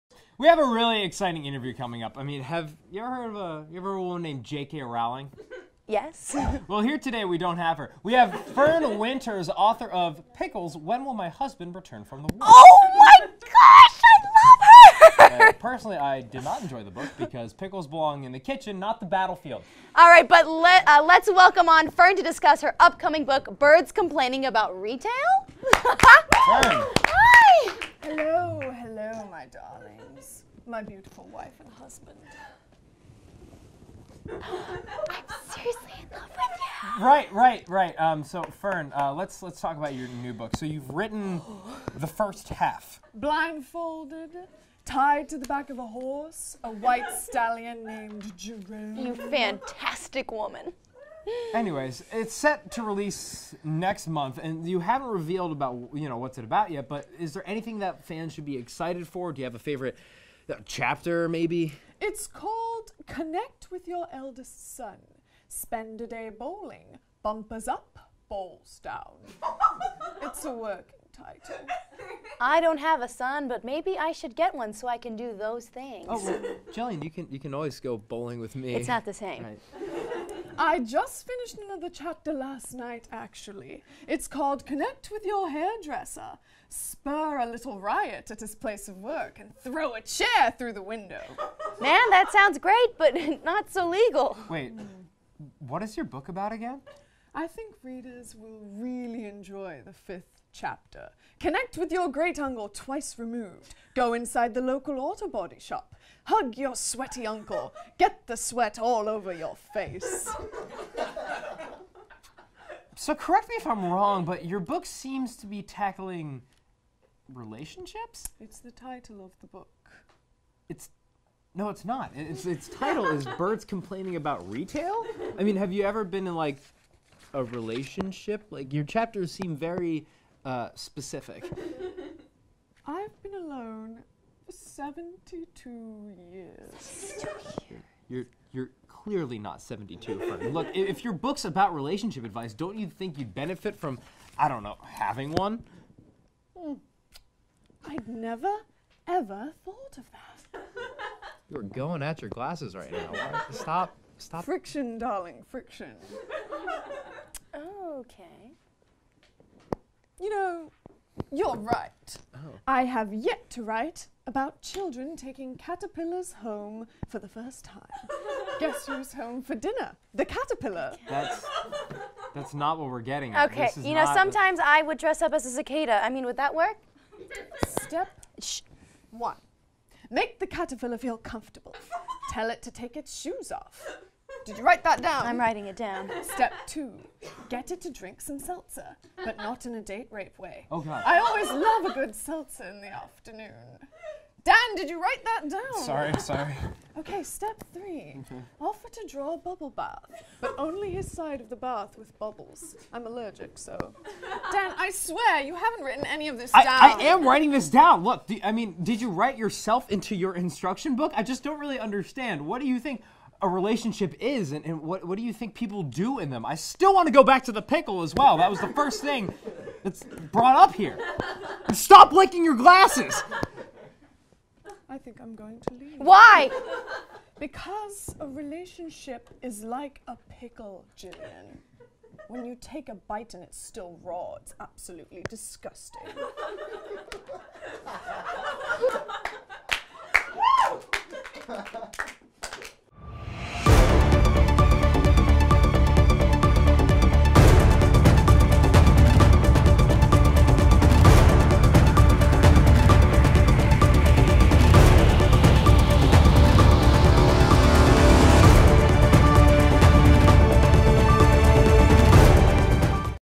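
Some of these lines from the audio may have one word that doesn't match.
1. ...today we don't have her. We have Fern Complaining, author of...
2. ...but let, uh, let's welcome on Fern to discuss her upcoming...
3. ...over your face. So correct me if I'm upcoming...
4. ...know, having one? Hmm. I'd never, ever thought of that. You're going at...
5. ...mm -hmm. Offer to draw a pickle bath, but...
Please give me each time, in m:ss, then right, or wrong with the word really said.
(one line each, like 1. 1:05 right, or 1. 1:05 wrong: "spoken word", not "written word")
1. 0:06 wrong: "Winters", not "Complaining"
2. 0:20 right
3. 1:49 wrong: "wrong", not "upcoming"
4. 2:24 right
5. 3:18 wrong: "bubble", not "pickle".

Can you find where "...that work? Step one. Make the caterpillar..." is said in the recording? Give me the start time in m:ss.
2:56.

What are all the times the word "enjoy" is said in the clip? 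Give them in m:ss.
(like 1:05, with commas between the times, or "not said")
0:16, 1:39.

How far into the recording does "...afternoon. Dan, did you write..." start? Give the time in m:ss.
3:12.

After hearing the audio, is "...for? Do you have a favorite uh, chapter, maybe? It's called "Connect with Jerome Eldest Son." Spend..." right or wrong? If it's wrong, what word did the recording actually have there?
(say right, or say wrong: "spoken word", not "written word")
wrong: "Your", not "Jerome".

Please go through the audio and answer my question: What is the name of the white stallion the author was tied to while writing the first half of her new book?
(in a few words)
Jerome.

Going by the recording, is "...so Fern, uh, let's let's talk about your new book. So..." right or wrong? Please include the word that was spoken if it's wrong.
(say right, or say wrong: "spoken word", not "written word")
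right.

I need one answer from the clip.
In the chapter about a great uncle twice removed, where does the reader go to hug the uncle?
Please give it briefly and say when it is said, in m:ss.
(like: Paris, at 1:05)
Local auto body shop, at 1:44.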